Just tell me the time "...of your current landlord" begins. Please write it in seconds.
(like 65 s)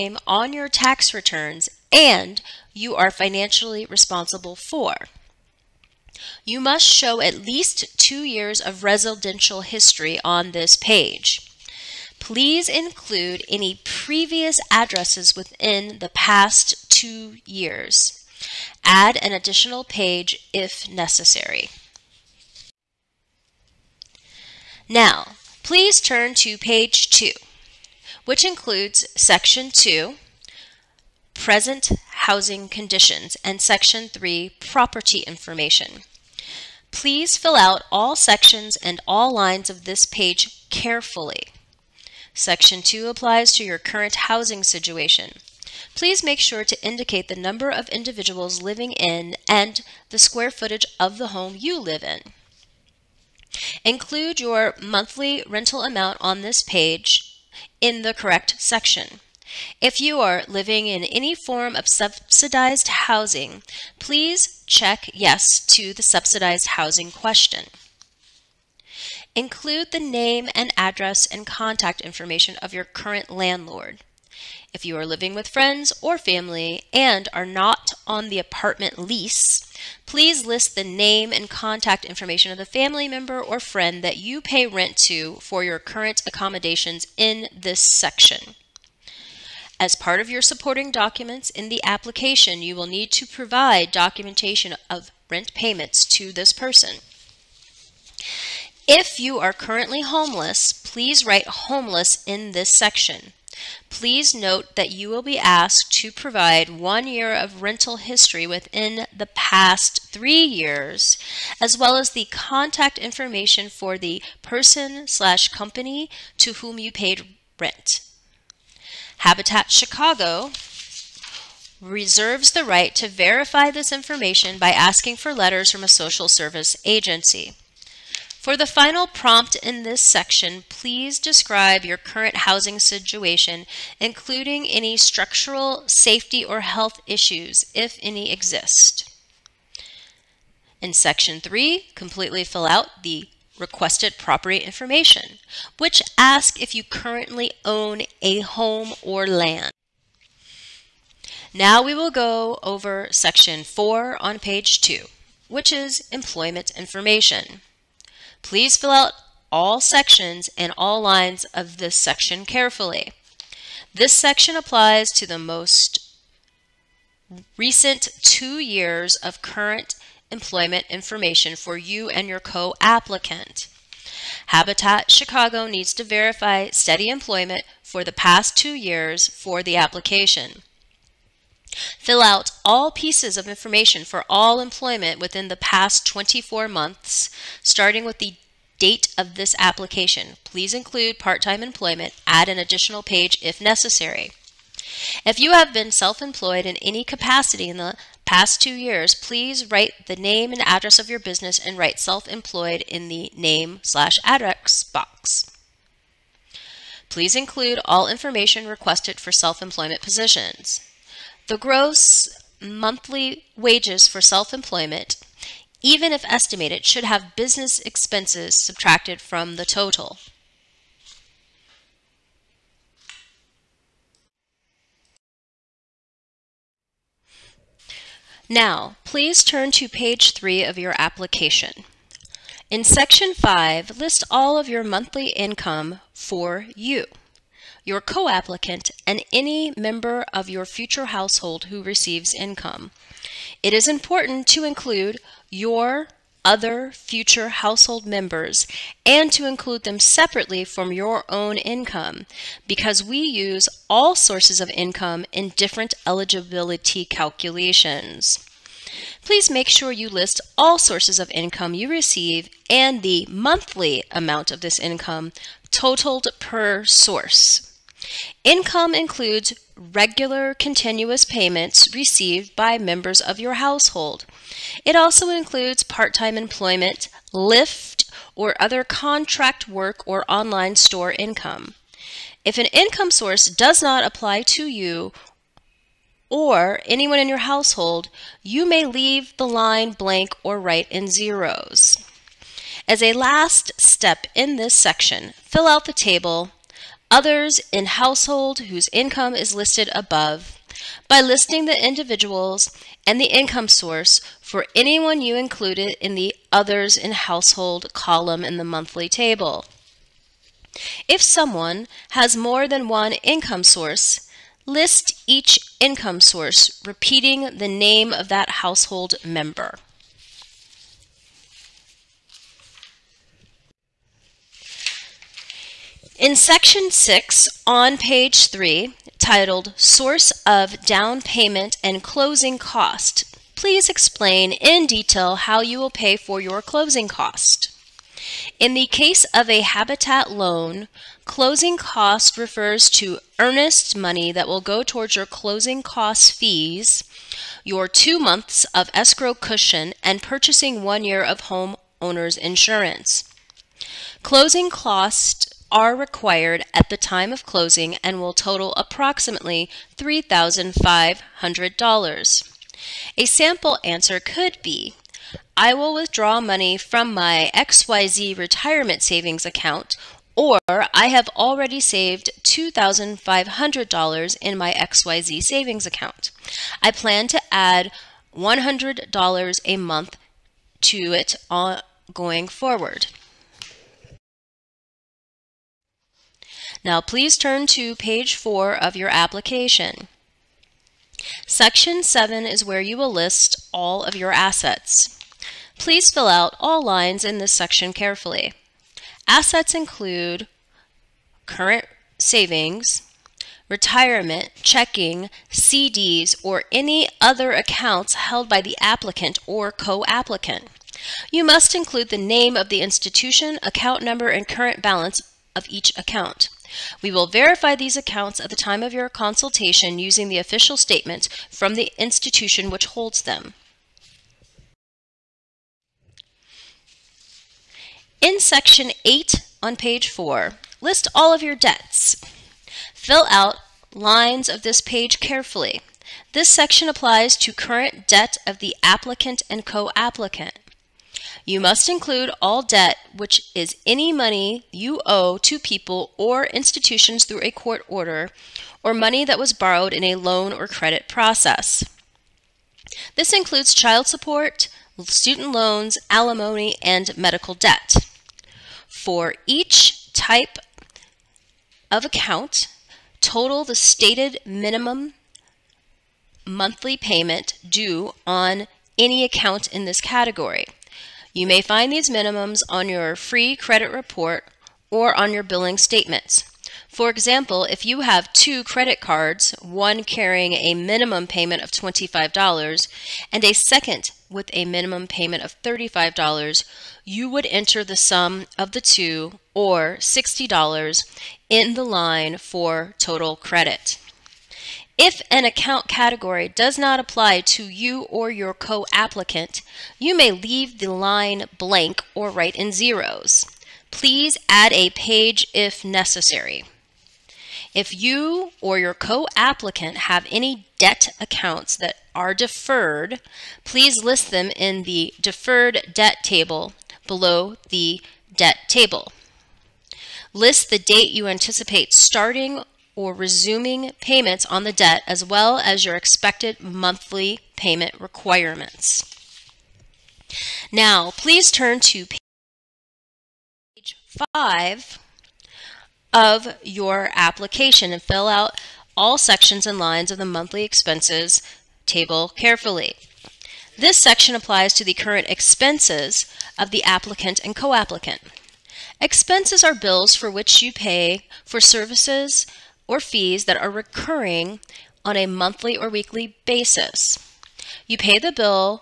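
72 s.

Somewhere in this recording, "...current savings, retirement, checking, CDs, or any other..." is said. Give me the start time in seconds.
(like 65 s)
401 s.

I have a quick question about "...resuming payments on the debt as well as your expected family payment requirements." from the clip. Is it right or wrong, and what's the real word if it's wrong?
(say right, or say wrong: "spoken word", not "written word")
wrong: "monthly", not "family".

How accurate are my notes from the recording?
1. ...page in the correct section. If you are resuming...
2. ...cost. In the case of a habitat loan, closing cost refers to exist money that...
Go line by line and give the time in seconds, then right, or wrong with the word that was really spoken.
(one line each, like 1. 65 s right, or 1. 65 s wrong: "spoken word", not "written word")
1. 56 s wrong: "living", not "resuming"
2. 337 s wrong: "earnest", not "exist".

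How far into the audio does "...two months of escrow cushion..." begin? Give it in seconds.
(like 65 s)
347 s.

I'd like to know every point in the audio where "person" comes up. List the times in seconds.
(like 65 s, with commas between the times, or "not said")
96 s, 114 s.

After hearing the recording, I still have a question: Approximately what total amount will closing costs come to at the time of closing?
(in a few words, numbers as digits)
$3,500.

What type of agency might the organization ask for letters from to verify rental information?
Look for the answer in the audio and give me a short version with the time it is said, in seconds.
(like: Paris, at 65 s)
social service agency, at 125 s.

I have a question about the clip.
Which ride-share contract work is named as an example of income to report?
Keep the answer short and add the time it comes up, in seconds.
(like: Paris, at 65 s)
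Lyft, at 277 s.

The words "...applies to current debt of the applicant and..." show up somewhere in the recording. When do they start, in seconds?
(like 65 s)
436 s.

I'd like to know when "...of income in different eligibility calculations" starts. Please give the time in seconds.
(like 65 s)
254 s.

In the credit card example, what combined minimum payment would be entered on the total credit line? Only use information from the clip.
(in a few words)
$60.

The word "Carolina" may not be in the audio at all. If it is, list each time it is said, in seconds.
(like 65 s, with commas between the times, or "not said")
not said.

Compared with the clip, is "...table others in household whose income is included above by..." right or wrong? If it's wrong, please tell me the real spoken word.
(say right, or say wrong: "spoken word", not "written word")
wrong: "listed", not "included".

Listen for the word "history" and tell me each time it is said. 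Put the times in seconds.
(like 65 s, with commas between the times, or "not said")
9 s, 108 s.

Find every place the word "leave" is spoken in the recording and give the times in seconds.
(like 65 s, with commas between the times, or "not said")
288 s, 500 s.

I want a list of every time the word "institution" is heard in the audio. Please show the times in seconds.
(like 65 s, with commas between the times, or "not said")
412 s, 421 s, 446 s.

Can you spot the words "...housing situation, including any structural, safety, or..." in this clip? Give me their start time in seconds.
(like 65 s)
132 s.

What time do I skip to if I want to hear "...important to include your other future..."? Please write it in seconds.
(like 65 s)
243 s.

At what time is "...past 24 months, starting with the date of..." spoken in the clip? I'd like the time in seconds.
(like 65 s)
185 s.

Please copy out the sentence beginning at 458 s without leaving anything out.
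For each type of account, total the stated minimum monthly payment due on any account in this category.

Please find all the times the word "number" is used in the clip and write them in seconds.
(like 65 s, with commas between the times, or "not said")
47 s, 414 s.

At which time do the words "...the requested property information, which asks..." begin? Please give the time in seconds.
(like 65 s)
143 s.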